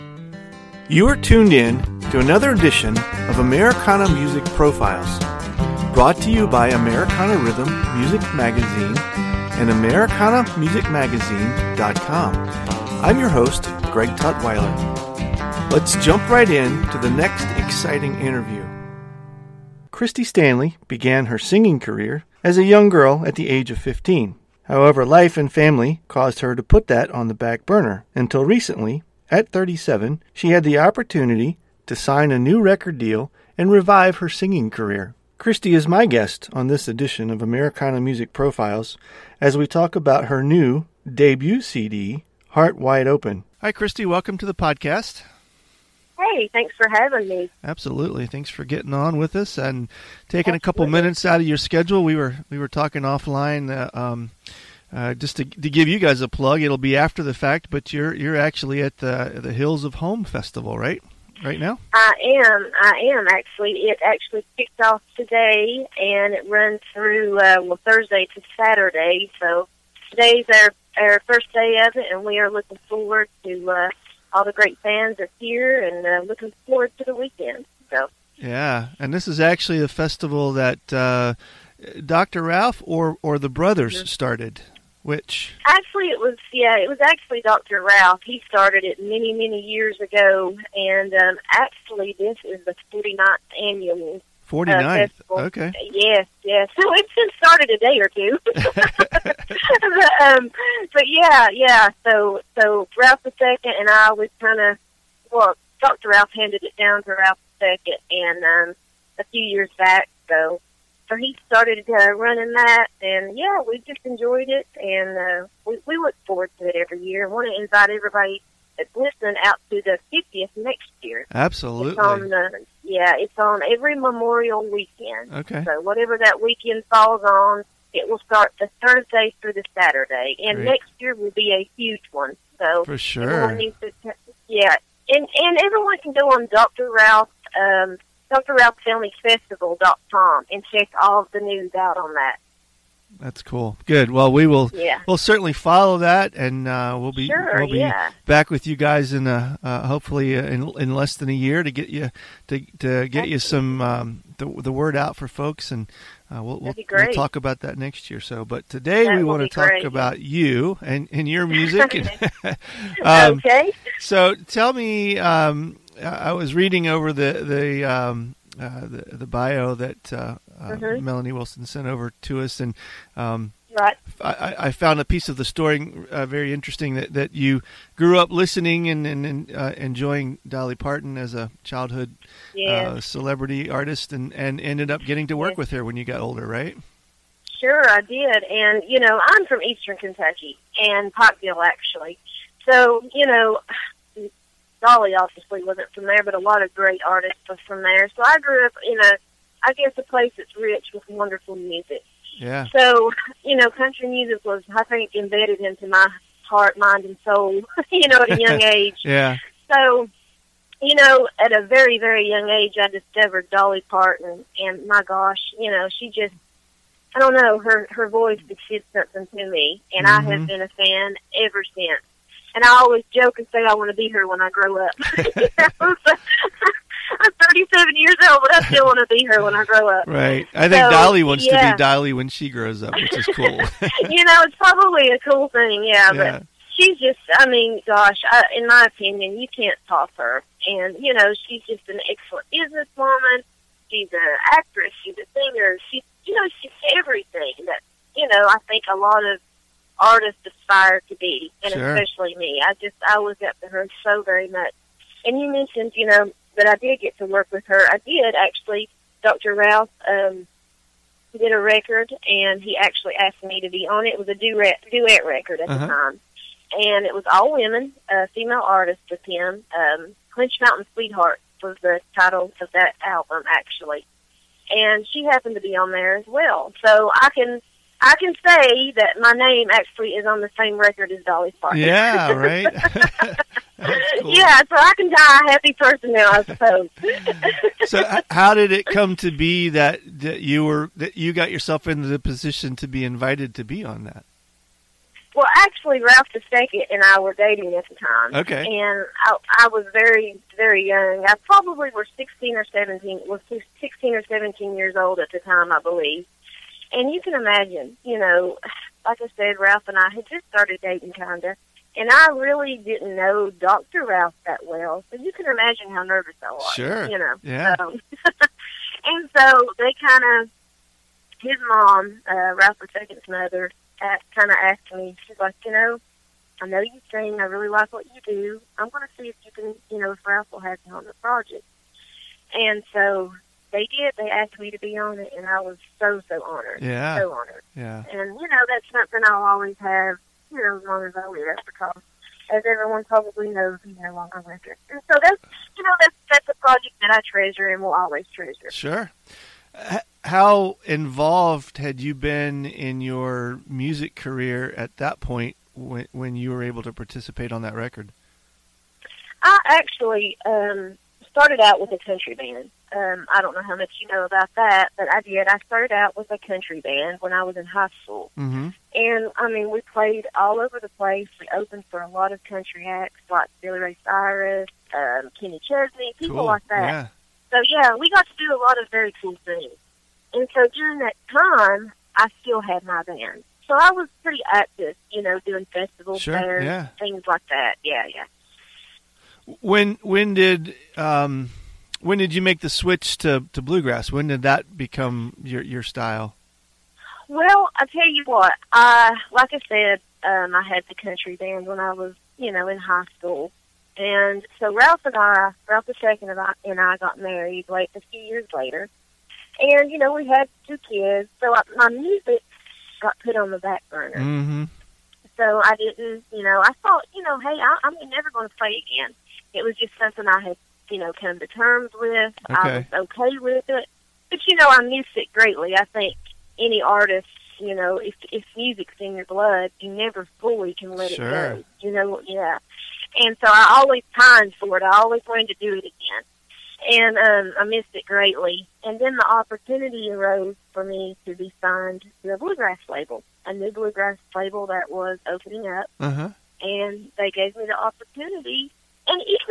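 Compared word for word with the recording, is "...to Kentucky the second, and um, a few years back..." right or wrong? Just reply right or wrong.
wrong.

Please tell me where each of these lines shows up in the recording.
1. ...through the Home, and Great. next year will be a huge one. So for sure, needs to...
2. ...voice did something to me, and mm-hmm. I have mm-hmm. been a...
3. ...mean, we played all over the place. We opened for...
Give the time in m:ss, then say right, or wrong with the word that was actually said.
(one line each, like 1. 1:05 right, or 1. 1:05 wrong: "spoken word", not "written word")
1. 2:09 wrong: "Saturday", not "Home"
2. 3:38 right
3. 6:09 right.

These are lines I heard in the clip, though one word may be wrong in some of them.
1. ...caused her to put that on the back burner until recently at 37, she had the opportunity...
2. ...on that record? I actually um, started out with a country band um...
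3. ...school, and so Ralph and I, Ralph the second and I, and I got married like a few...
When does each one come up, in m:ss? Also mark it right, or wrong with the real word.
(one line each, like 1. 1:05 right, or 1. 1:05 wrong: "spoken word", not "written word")
1. 0:26 right
2. 5:57 right
3. 6:43 right.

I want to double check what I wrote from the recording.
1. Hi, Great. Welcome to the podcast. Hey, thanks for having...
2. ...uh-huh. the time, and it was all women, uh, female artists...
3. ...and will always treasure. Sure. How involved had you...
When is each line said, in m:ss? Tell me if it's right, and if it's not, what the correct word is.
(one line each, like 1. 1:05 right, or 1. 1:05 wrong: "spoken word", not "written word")
1. 0:43 wrong: "Kristi", not "Great"
2. 4:25 right
3. 5:47 right.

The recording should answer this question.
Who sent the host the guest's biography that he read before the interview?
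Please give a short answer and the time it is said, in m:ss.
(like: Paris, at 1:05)
Melanie Wilson, at 2:51.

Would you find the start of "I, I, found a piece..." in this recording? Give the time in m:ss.
2:54.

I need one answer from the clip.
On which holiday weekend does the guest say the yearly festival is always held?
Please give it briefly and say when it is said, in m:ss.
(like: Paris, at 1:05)
Memorial weekend, at 2:03.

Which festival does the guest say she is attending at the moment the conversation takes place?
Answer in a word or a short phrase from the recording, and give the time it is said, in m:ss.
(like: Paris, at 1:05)
Hills of Home Festival, at 0:59.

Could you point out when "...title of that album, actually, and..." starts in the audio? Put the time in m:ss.
4:32.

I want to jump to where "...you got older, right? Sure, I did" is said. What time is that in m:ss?
3:05.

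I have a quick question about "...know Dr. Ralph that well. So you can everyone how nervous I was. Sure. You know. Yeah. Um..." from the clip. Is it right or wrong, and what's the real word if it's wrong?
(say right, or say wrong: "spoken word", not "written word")
wrong: "imagine", not "everyone".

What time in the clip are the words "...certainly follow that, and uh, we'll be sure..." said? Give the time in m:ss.
2:25.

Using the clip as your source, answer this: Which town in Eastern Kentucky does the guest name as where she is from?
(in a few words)
Pikeville.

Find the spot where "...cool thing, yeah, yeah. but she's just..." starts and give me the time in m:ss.
3:55.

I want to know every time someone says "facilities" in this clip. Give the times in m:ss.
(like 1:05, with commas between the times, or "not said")
not said.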